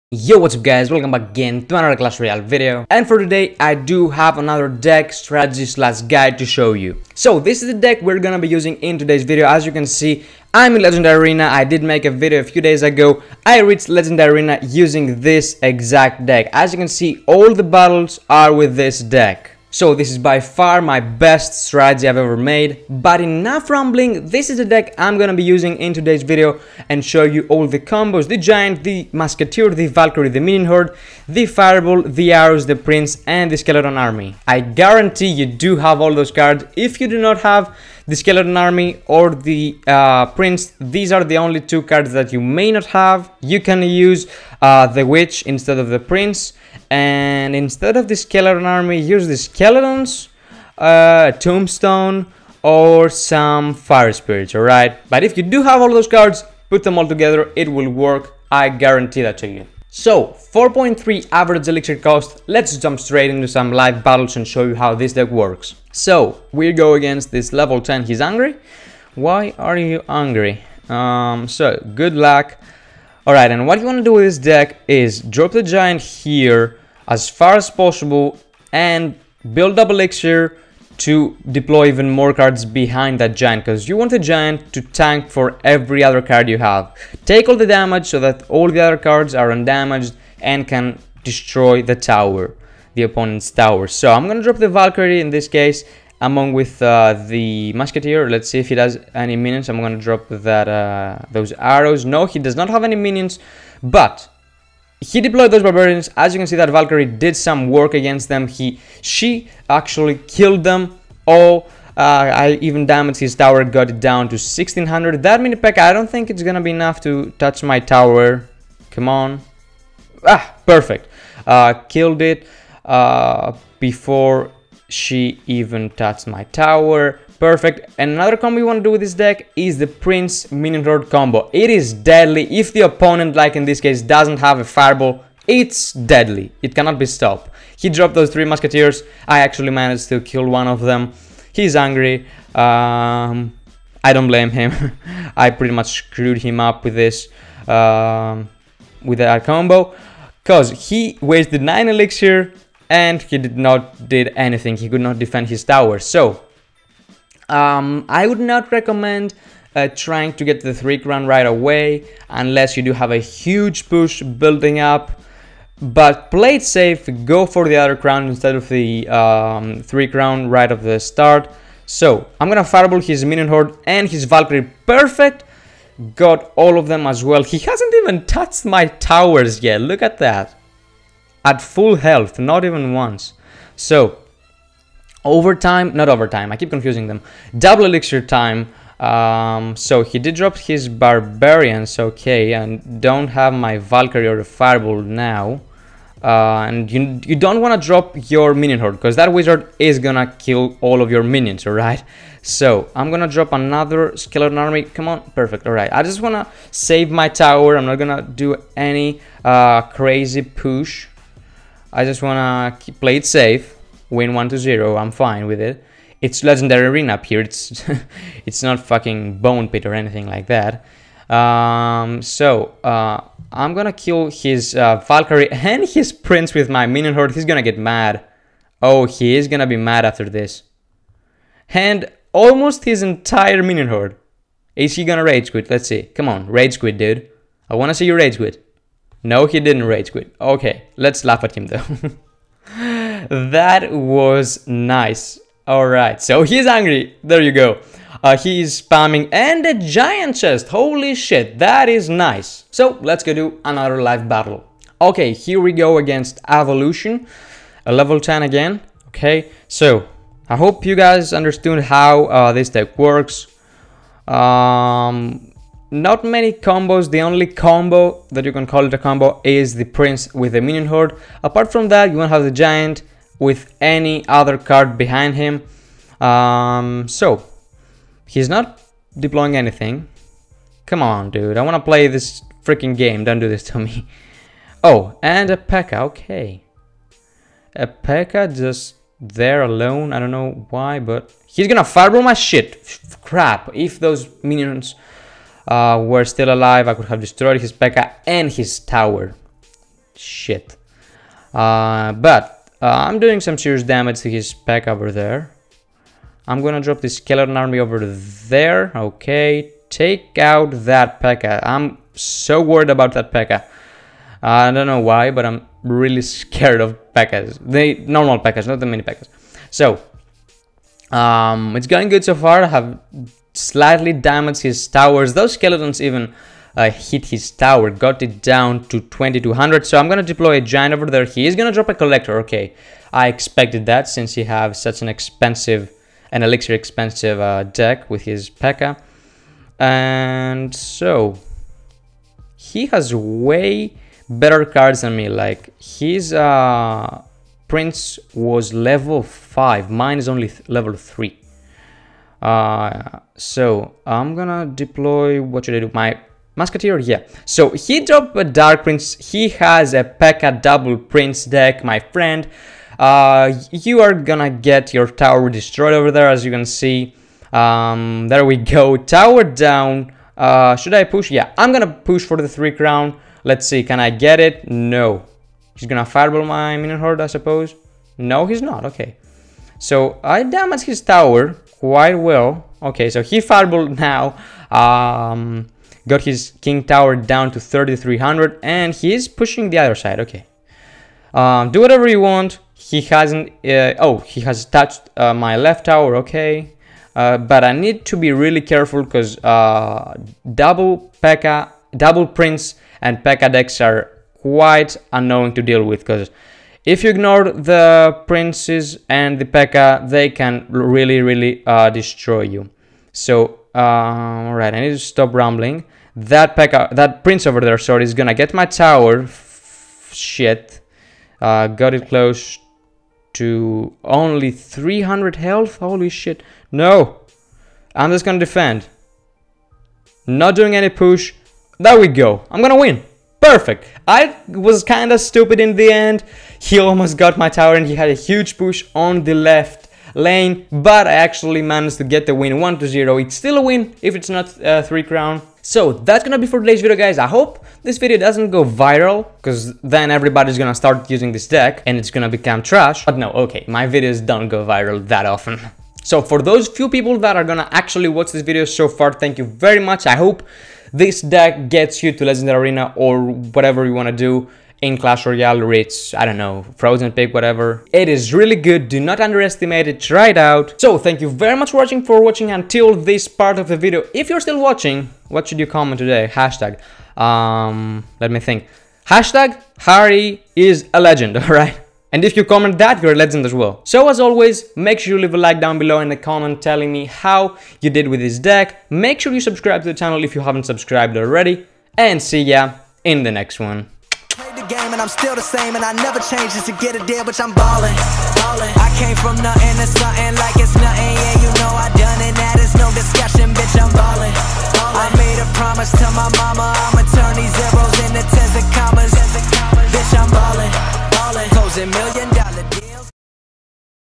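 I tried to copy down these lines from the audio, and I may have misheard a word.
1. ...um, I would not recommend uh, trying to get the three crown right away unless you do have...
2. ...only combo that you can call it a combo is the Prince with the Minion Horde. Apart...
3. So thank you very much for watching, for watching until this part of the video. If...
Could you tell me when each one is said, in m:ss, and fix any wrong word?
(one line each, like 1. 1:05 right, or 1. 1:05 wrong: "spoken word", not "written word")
1. 2:37 right
2. 4:27 right
3. 7:50 right.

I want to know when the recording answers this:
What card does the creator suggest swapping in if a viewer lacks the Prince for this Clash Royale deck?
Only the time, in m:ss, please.
0:44.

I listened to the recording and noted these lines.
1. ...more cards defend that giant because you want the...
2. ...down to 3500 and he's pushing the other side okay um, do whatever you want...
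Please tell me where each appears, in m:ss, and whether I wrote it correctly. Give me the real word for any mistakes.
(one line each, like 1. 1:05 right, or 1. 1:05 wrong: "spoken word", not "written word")
1. 1:22 wrong: "behind", not "defend"
2. 6:27 wrong: "3300", not "3500".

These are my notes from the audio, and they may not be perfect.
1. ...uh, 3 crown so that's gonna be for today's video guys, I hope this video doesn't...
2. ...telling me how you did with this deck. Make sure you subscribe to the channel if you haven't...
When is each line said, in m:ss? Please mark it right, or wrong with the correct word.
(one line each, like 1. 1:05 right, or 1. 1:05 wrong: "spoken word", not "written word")
1. 7:24 right
2. 8:06 right.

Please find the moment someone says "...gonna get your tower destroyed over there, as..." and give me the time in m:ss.
6:04.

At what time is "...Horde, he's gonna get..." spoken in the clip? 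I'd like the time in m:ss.
3:47.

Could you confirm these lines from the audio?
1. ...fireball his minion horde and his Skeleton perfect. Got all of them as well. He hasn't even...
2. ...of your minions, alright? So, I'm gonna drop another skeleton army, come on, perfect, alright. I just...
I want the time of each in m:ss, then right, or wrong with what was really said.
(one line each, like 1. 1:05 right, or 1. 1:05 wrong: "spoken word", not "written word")
1. 2:52 wrong: "Valkyrie", not "Skeleton"
2. 3:21 right.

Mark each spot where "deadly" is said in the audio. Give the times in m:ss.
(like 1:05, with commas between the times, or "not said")
2:11, 2:15.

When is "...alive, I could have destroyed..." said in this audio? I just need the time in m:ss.
4:56.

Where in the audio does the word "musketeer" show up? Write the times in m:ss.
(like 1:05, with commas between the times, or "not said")
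0:29, 1:37, 2:18, 5:56.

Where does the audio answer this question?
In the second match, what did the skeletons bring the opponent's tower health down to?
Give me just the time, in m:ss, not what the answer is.
5:28.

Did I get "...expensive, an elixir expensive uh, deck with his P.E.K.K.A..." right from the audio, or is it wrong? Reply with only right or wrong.
right.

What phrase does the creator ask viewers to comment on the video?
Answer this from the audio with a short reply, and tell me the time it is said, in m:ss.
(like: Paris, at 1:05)
Harry is a legend, at 7:59.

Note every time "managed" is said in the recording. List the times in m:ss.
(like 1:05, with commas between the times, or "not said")
2:19, 7:21.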